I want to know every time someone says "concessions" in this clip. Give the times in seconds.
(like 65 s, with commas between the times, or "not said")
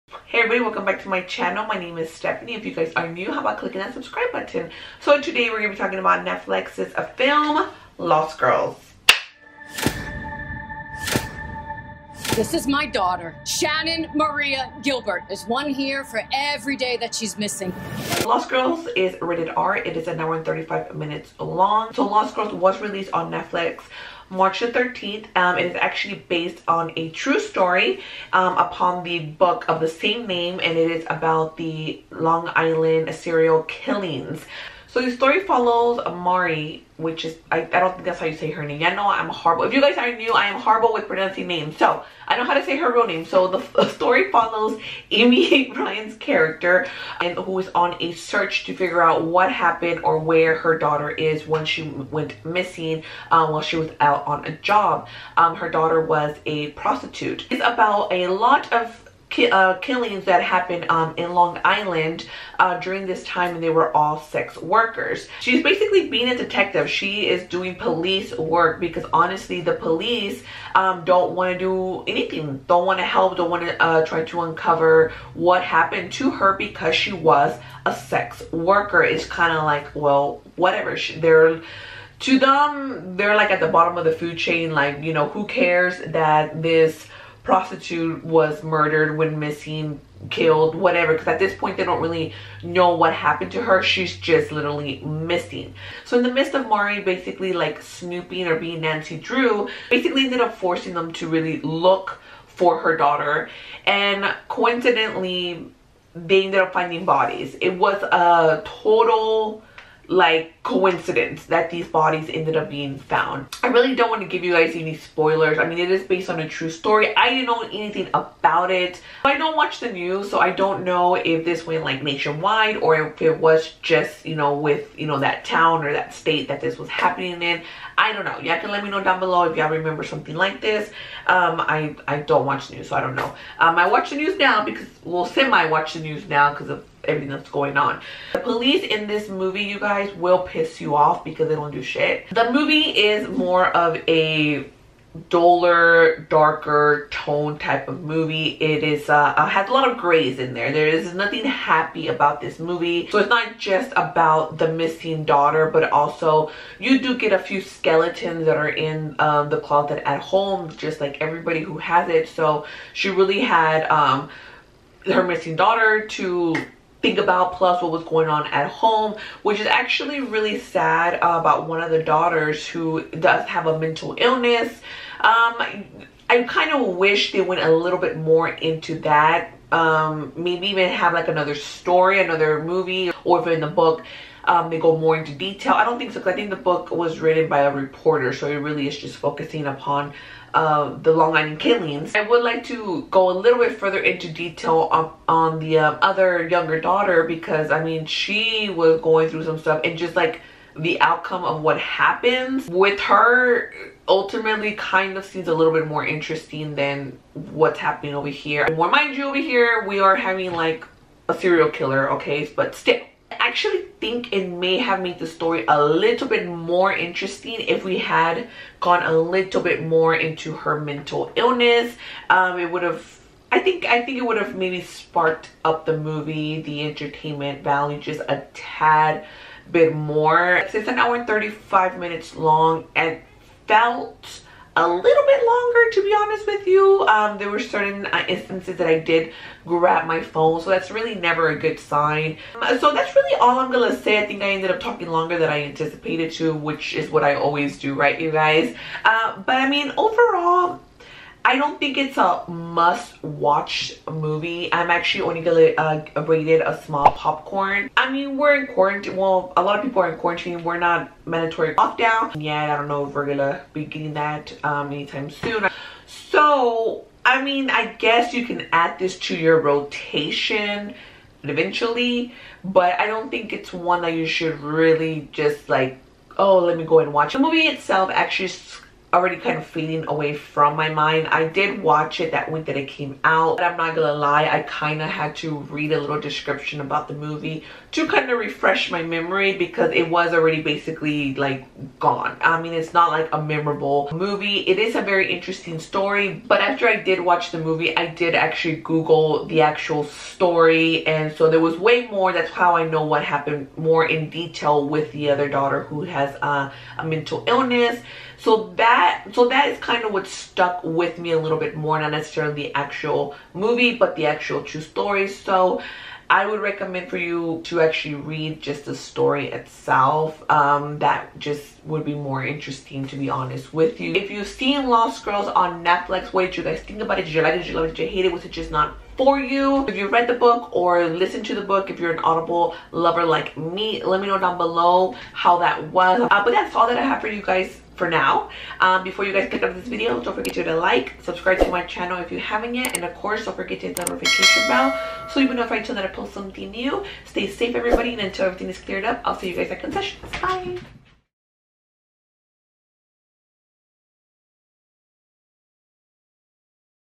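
349 s.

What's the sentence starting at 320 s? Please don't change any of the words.
Um, that just would be more interesting to be honest with you.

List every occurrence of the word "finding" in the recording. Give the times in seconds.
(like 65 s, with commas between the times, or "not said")
106 s.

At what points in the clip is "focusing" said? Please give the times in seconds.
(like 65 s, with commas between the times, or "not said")
189 s.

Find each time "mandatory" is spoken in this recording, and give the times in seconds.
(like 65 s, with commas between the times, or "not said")
261 s.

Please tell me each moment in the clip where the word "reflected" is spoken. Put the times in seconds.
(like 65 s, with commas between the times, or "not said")
not said.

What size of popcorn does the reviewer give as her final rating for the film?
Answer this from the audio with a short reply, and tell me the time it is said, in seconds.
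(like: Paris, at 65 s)
Small, at 256 s.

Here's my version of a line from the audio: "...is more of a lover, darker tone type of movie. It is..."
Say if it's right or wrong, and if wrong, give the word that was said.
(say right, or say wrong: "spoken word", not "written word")
wrong: "duller", not "lover".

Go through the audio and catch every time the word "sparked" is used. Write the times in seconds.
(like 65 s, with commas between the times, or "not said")
224 s.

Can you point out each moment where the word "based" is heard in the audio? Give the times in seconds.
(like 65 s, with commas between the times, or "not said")
26 s, 116 s.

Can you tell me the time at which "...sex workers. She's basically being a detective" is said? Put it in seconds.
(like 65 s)
64 s.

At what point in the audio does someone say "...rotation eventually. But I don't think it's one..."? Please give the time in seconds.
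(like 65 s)
269 s.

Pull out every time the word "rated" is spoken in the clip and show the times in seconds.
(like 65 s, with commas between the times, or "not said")
19 s, 256 s.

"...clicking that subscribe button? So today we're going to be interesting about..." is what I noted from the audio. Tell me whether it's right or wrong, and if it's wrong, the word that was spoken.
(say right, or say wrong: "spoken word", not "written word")
wrong: "talking", not "interesting".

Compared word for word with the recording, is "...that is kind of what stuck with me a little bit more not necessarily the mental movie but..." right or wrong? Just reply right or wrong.
wrong.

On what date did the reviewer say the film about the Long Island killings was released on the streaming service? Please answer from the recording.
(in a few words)
March 13.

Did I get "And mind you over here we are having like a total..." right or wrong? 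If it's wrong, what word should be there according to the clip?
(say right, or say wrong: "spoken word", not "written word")
wrong: "serial", not "total".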